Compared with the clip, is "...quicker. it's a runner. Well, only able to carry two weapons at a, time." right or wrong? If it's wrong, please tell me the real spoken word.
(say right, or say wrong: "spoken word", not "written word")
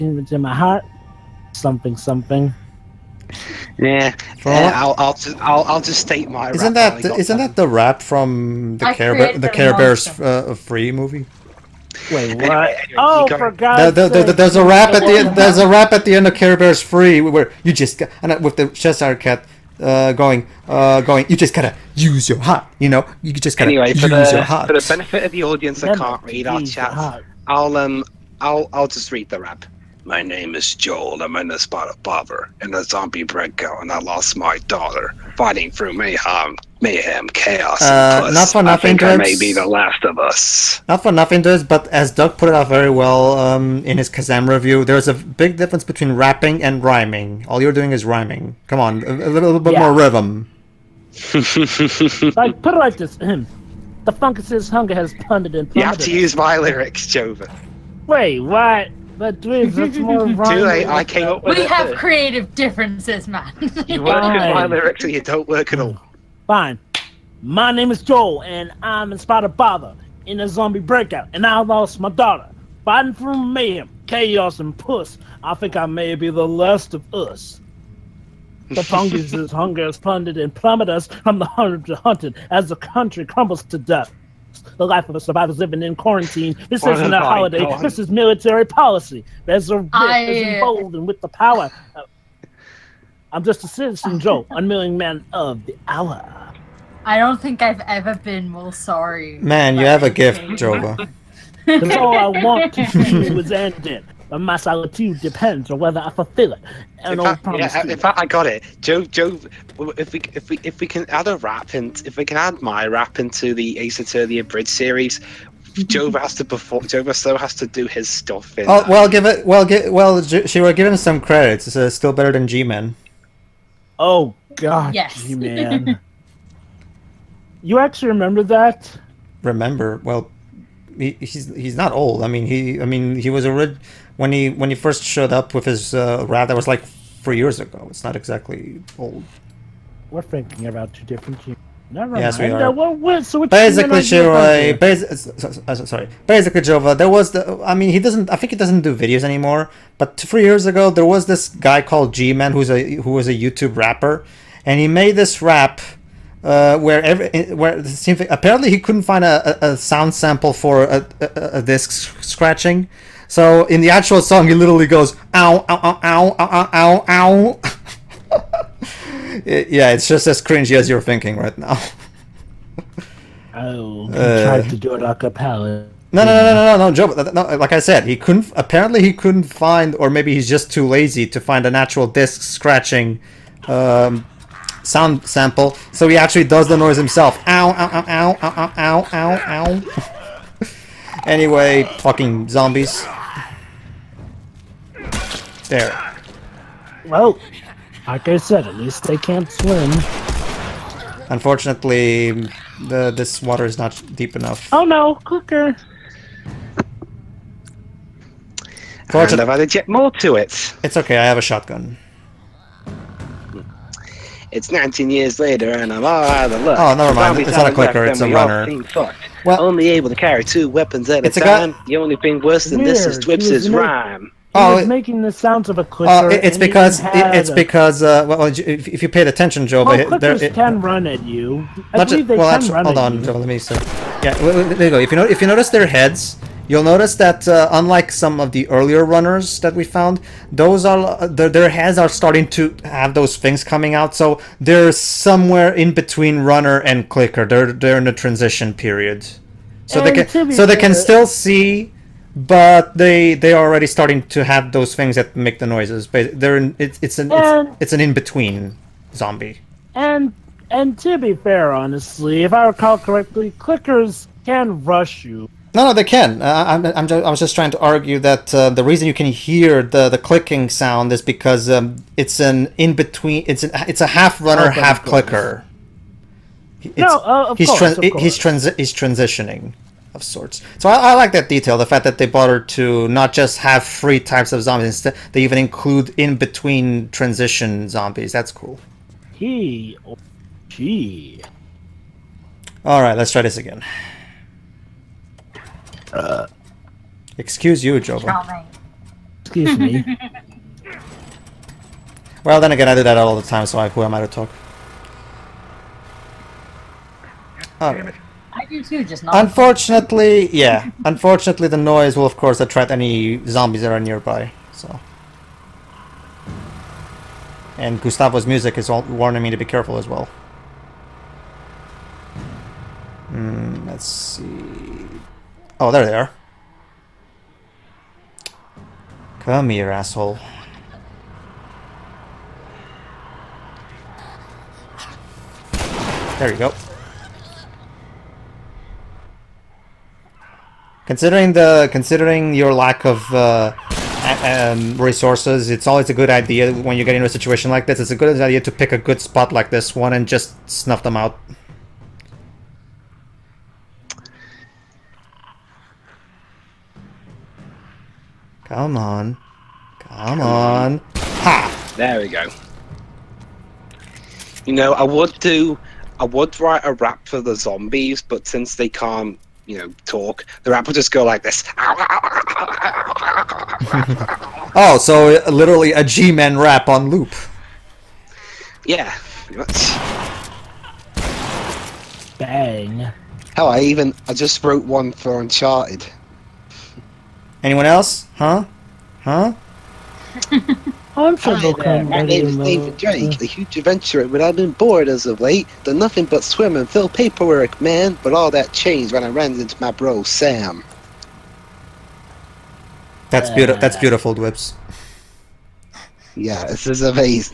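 right.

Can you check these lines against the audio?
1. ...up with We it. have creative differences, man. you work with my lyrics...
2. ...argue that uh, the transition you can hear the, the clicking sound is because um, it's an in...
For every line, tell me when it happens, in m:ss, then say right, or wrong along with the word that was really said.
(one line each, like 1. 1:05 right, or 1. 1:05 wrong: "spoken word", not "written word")
1. 1:01 right
2. 4:27 wrong: "reason", not "transition".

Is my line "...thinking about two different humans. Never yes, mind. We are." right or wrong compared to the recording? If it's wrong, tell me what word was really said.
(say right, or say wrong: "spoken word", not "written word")
right.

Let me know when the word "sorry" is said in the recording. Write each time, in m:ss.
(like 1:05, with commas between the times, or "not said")
1:38, 2:25.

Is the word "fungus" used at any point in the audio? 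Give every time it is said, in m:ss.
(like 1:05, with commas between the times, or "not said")
0:54, 1:18.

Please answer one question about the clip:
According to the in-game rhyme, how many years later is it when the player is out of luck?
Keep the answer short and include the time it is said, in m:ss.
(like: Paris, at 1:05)
19, at 3:34.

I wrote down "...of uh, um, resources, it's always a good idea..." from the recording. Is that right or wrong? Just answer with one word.
right.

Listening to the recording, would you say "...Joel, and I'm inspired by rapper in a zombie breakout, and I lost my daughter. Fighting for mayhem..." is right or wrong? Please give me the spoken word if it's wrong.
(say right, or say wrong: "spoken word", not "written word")
wrong: "bother", not "rapper".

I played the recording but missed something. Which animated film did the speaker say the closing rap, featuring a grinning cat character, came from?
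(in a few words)
Care Bears 3.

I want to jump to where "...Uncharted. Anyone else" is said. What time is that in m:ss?
6:25.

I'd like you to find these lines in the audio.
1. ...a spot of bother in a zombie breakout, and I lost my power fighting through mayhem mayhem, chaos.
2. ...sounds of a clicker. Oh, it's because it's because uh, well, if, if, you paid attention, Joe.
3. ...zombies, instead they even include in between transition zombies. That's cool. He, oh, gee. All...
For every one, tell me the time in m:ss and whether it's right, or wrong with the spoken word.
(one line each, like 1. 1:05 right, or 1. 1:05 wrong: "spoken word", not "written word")
1. 0:31 wrong: "daughter", not "power"
2. 3:45 right
3. 4:44 right.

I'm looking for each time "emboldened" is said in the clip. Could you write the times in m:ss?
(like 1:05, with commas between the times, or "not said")
1:30.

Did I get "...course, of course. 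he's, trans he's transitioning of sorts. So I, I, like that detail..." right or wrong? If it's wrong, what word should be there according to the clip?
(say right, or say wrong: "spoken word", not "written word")
right.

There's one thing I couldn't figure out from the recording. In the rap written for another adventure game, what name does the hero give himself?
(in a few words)
David Drake.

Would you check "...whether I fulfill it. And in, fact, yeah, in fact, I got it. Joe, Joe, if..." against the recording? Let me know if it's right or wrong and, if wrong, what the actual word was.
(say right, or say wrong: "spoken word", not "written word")
right.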